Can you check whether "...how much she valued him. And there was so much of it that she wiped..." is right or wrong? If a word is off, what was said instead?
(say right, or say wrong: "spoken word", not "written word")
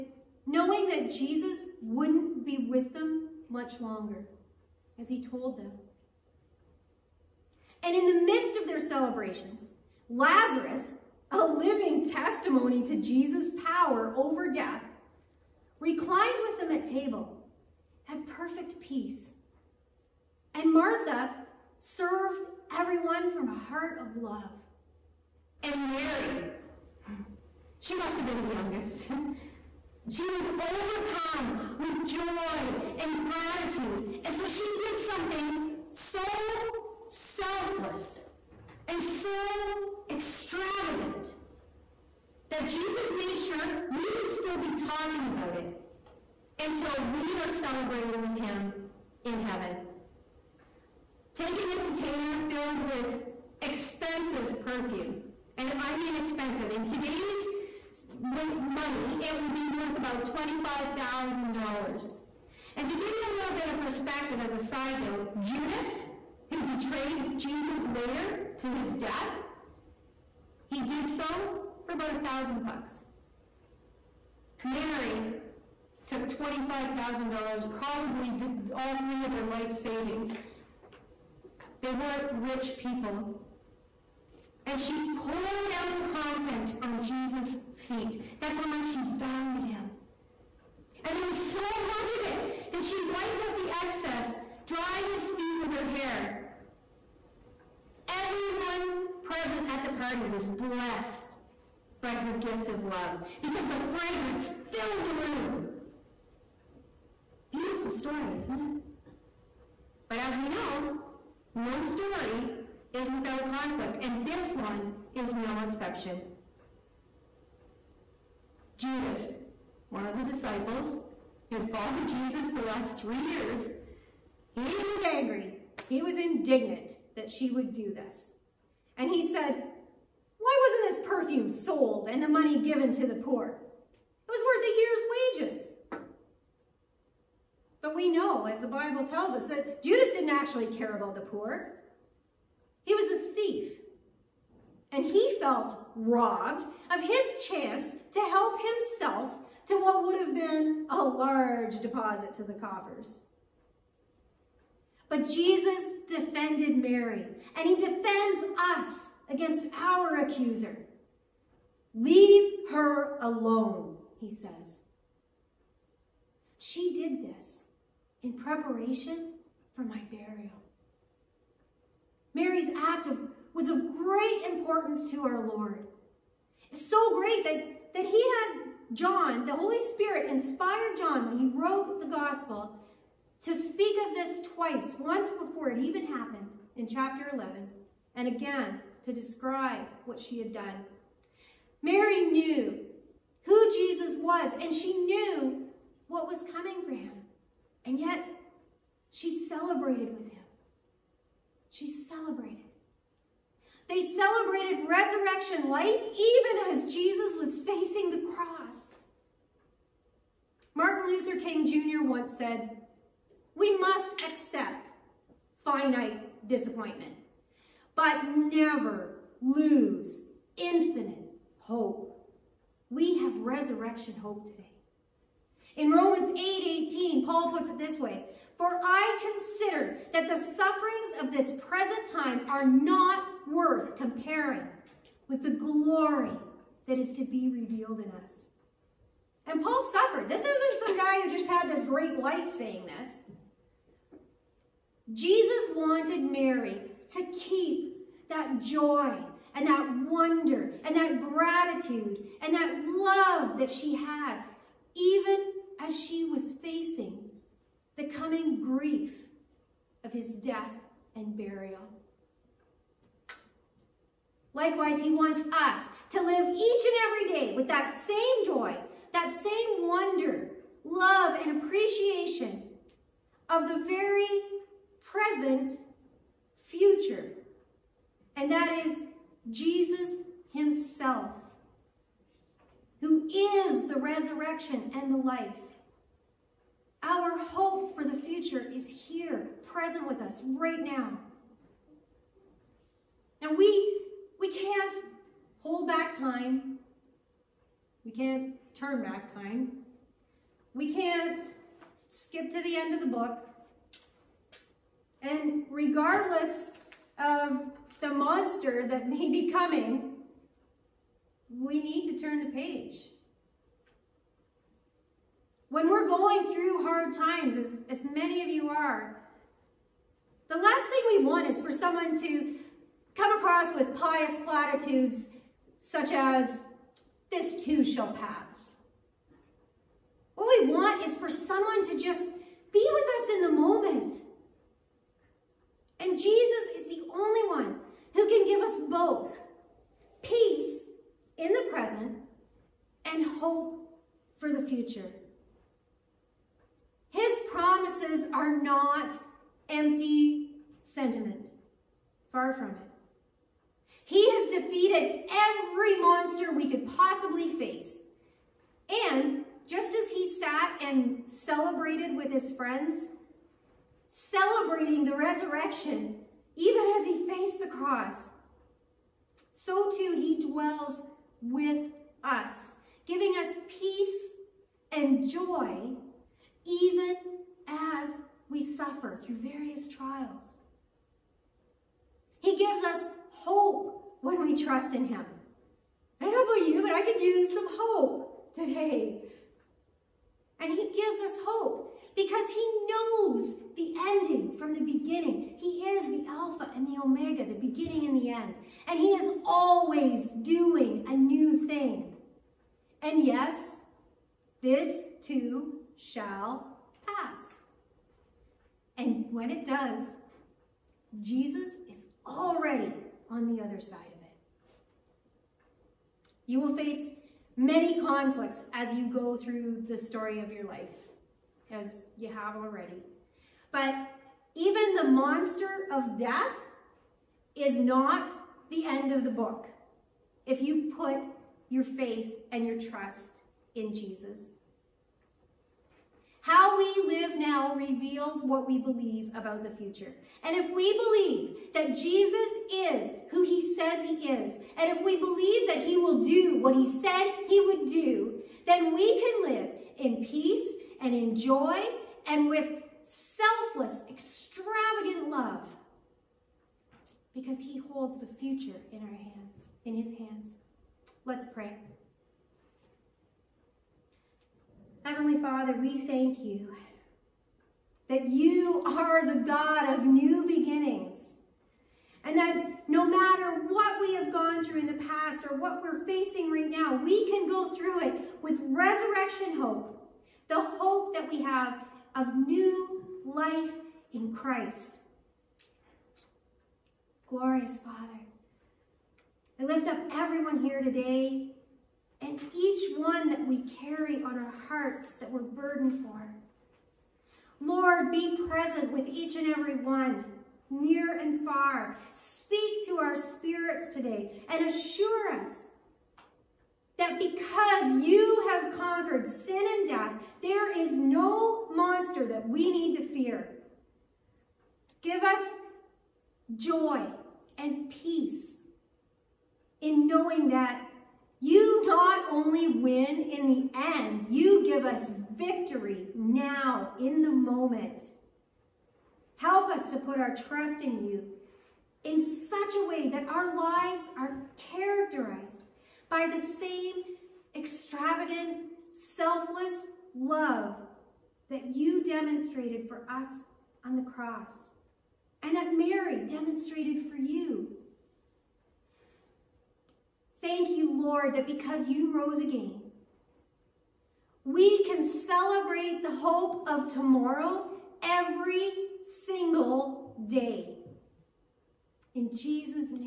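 right.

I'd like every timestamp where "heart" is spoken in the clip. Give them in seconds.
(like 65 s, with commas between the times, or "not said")
23 s, 494 s.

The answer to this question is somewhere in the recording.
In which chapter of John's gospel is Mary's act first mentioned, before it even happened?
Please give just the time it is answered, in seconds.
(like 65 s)
186 s.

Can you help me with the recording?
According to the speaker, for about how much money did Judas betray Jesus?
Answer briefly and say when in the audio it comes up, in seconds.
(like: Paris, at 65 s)
about a thousand bucks, at 71 s.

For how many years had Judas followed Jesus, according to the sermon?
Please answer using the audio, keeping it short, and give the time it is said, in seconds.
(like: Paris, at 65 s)
3 years, at 123 s.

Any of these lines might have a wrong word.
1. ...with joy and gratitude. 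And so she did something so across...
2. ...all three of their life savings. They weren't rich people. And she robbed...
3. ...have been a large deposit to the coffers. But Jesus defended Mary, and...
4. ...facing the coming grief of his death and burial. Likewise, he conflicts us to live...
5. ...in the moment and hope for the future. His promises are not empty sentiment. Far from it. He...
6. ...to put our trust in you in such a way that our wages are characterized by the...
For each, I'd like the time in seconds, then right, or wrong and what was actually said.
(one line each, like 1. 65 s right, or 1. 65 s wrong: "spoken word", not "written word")
1. 31 s wrong: "selfless", not "across"
2. 78 s wrong: "poured", not "robbed"
3. 150 s right
4. 256 s wrong: "wants", not "conflicts"
5. 341 s wrong: "present", not "moment"
6. 529 s wrong: "lives", not "wages".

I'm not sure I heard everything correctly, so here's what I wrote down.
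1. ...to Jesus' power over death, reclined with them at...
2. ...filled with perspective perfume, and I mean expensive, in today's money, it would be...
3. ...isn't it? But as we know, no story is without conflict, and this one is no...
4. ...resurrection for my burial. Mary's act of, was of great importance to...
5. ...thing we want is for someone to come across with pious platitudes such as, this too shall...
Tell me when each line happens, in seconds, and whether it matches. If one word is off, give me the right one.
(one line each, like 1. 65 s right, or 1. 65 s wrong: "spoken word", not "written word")
1. 12 s right
2. 52 s wrong: "expensive", not "perspective"
3. 108 s right
4. 168 s wrong: "preparation", not "resurrection"
5. 320 s right.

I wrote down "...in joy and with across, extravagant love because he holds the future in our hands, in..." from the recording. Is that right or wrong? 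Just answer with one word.
wrong.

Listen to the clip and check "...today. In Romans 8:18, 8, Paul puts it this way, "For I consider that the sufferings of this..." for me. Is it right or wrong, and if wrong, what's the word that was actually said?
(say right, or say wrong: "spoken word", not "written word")
right.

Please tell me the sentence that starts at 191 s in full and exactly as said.
Mary knew who Jesus was, and she knew what was coming for him.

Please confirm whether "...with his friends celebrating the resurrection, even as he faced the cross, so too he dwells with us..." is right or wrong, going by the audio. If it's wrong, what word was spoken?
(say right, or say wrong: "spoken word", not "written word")
right.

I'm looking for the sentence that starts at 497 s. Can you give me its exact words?
Lord, be present with each and every one, near and far.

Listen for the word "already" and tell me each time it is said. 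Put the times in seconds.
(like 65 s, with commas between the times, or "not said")
412 s, 422 s.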